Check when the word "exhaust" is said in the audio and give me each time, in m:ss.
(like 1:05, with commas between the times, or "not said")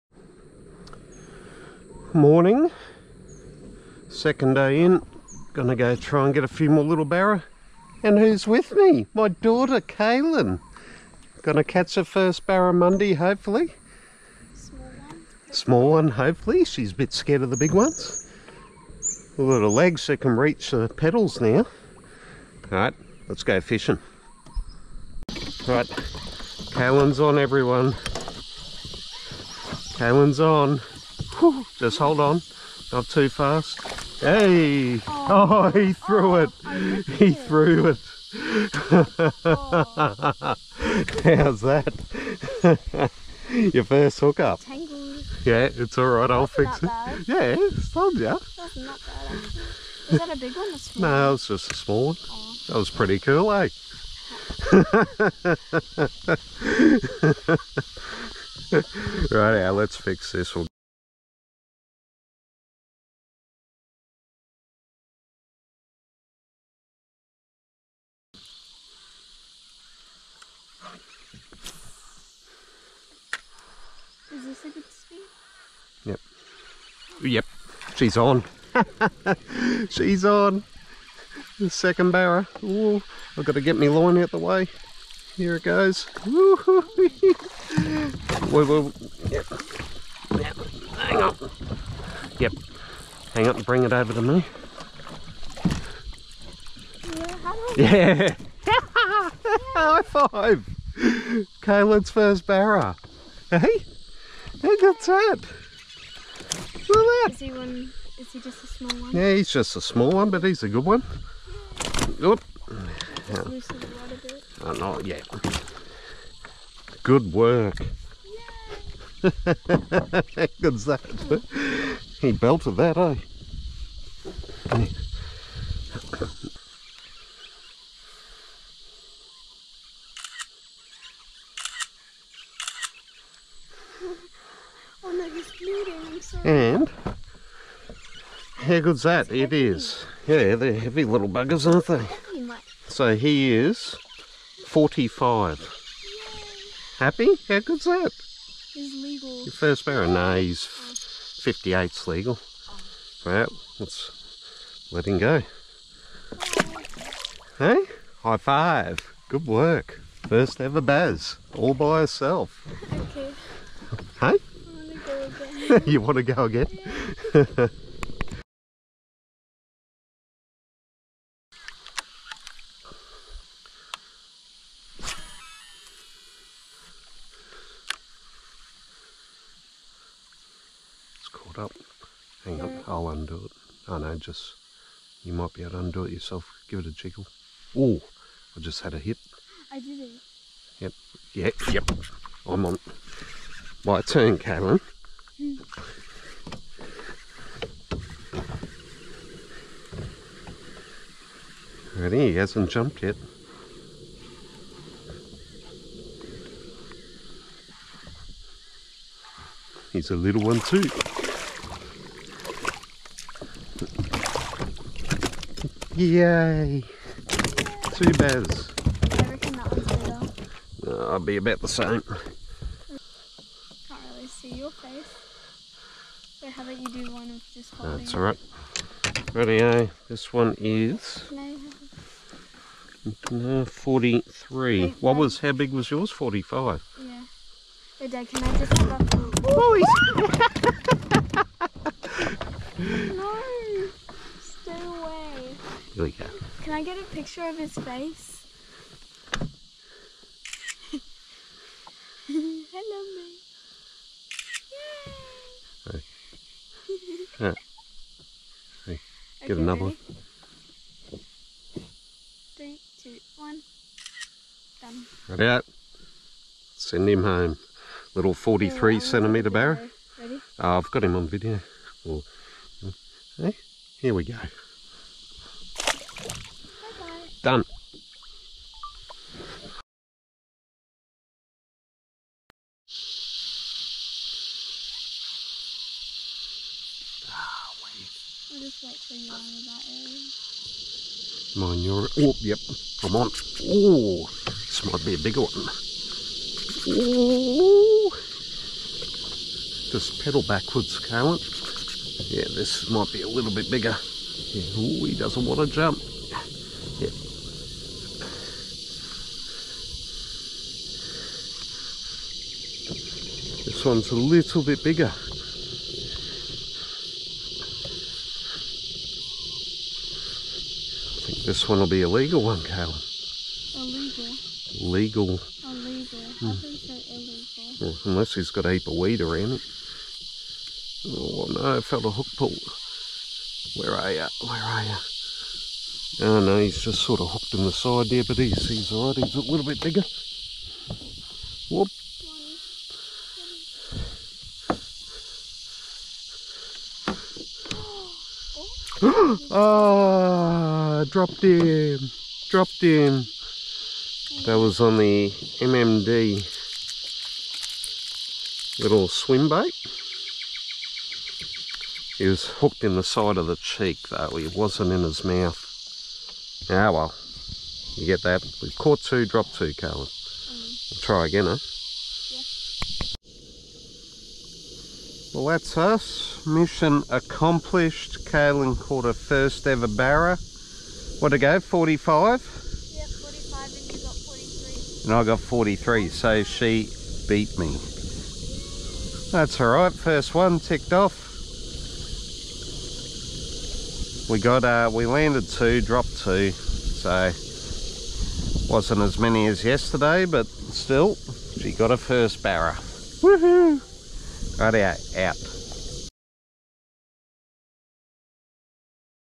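not said.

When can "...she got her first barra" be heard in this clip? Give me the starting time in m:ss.
6:41.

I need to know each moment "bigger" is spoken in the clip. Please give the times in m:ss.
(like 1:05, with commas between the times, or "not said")
4:55, 5:03, 5:14, 5:39.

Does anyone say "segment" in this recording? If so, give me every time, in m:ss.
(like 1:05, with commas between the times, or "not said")
not said.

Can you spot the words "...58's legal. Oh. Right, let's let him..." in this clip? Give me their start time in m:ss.
2:30.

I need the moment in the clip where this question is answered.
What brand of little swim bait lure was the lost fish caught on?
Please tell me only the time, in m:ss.
5:55.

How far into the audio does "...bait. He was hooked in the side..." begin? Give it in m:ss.
5:59.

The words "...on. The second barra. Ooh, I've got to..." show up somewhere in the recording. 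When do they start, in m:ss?
1:20.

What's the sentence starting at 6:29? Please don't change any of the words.
That's alright, first one ticked off.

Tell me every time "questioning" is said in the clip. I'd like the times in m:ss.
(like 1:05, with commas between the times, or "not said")
not said.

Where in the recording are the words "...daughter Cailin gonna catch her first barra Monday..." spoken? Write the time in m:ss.
0:09.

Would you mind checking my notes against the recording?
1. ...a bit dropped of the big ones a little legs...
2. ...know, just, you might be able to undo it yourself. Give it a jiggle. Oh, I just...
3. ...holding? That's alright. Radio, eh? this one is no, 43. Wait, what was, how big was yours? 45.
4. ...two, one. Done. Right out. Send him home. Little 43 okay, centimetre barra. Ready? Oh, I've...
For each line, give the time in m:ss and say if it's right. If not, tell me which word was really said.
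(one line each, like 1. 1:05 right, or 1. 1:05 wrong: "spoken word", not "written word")
1. 0:16 wrong: "scared", not "dropped"
2. 3:03 right
3. 3:47 right
4. 4:23 right.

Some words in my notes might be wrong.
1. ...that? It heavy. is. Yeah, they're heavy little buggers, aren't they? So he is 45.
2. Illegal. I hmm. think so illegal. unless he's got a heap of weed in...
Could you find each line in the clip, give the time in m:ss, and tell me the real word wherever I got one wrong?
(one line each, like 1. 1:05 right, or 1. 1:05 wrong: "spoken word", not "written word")
1. 2:19 right
2. 5:25 right.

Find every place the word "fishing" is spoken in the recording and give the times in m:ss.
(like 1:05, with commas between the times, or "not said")
0:23.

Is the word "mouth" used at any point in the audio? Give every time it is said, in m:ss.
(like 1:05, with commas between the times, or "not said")
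6:05.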